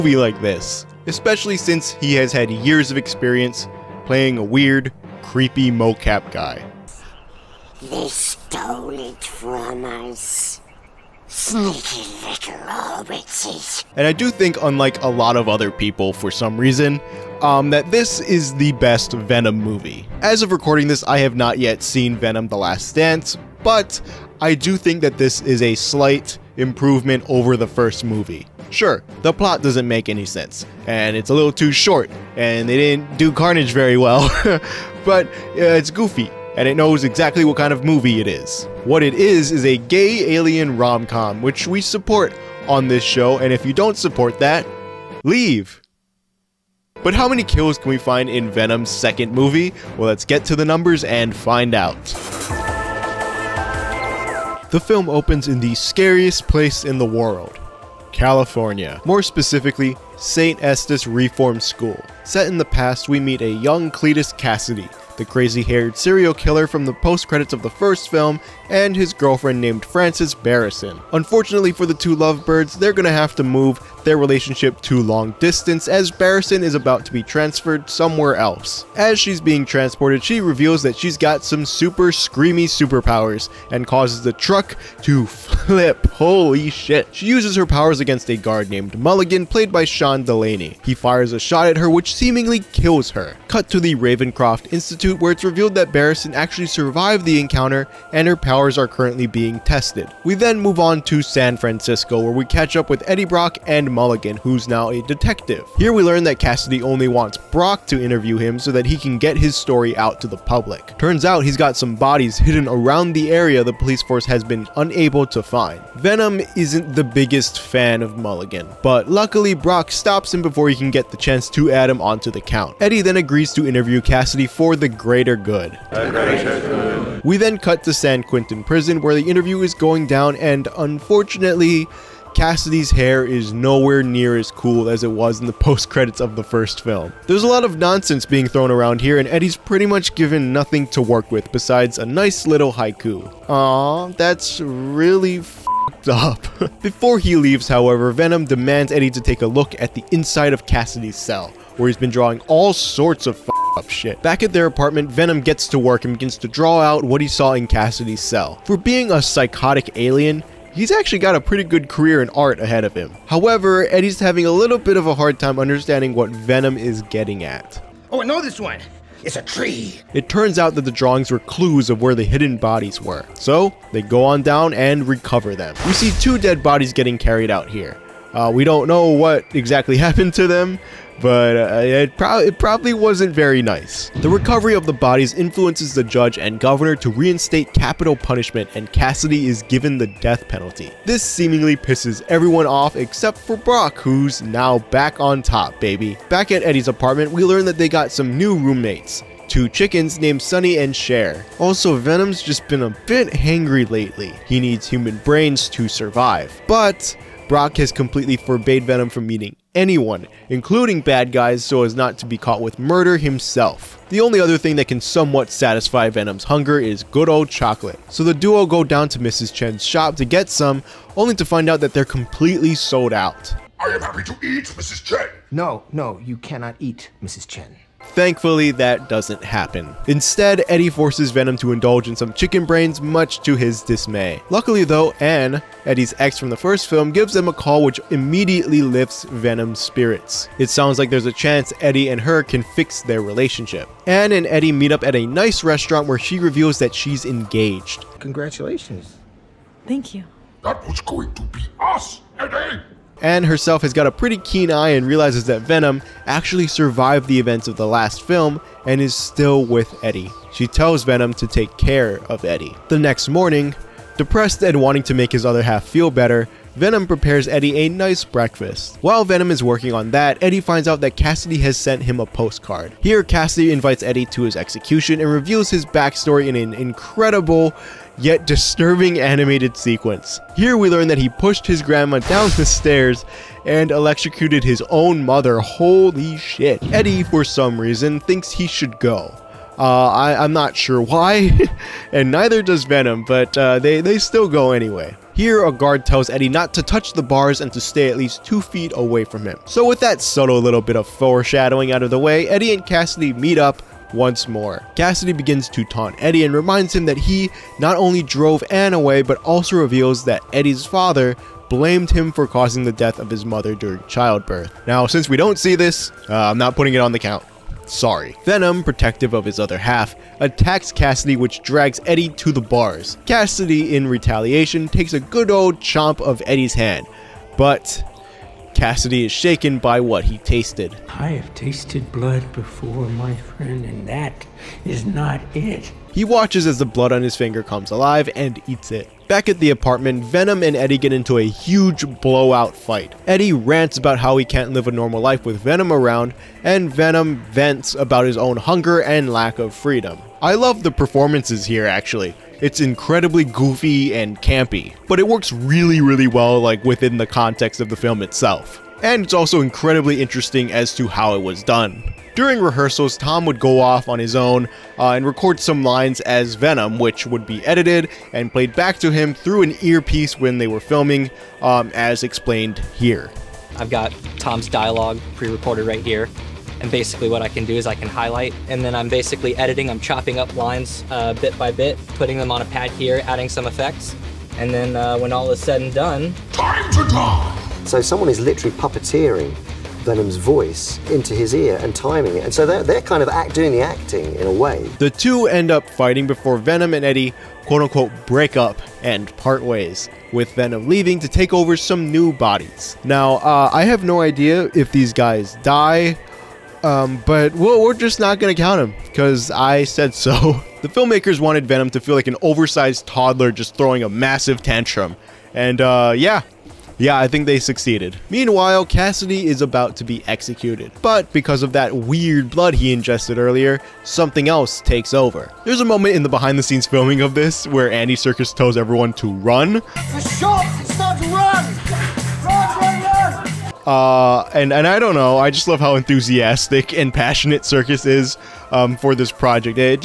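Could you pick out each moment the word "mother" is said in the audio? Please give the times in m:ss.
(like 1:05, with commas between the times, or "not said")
4:45, 5:13.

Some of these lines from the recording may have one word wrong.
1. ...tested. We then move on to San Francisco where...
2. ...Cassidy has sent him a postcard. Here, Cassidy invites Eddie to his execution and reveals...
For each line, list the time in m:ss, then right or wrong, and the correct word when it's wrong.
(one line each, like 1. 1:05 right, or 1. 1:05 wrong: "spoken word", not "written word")
1. 1:39 right
2. 4:31 right.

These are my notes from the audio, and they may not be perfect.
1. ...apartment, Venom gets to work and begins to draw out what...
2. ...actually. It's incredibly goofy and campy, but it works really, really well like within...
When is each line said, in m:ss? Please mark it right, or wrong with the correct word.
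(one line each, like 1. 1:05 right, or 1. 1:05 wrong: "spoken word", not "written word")
1. 2:34 right
2. 5:51 right.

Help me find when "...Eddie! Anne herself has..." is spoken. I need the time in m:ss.
4:12.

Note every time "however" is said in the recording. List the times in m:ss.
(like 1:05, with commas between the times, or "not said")
2:27, 2:43.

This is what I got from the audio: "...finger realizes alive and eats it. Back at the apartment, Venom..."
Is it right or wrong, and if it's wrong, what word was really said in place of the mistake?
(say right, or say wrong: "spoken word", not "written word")
wrong: "comes", not "realizes".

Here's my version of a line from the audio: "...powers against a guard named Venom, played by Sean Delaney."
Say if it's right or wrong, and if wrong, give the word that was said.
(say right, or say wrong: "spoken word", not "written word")
wrong: "Mulligan", not "Venom".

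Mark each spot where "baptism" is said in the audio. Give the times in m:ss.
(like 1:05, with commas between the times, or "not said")
not said.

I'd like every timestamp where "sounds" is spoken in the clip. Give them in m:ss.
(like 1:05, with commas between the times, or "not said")
4:00.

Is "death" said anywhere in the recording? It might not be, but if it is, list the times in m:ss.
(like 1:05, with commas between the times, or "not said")
3:10, 5:12.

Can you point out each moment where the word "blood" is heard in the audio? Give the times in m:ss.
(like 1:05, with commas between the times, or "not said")
5:32, 5:36, 7:02.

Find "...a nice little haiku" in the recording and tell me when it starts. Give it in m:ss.
2:21.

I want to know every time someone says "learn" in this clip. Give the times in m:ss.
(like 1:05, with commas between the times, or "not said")
1:46, 3:17, 4:40.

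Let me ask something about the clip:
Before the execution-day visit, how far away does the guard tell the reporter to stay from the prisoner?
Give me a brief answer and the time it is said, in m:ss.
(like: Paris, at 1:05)
2 feet, at 4:58.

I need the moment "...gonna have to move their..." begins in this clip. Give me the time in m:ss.
1:12.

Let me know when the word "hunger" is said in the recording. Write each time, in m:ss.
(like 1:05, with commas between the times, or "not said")
3:36, 5:48.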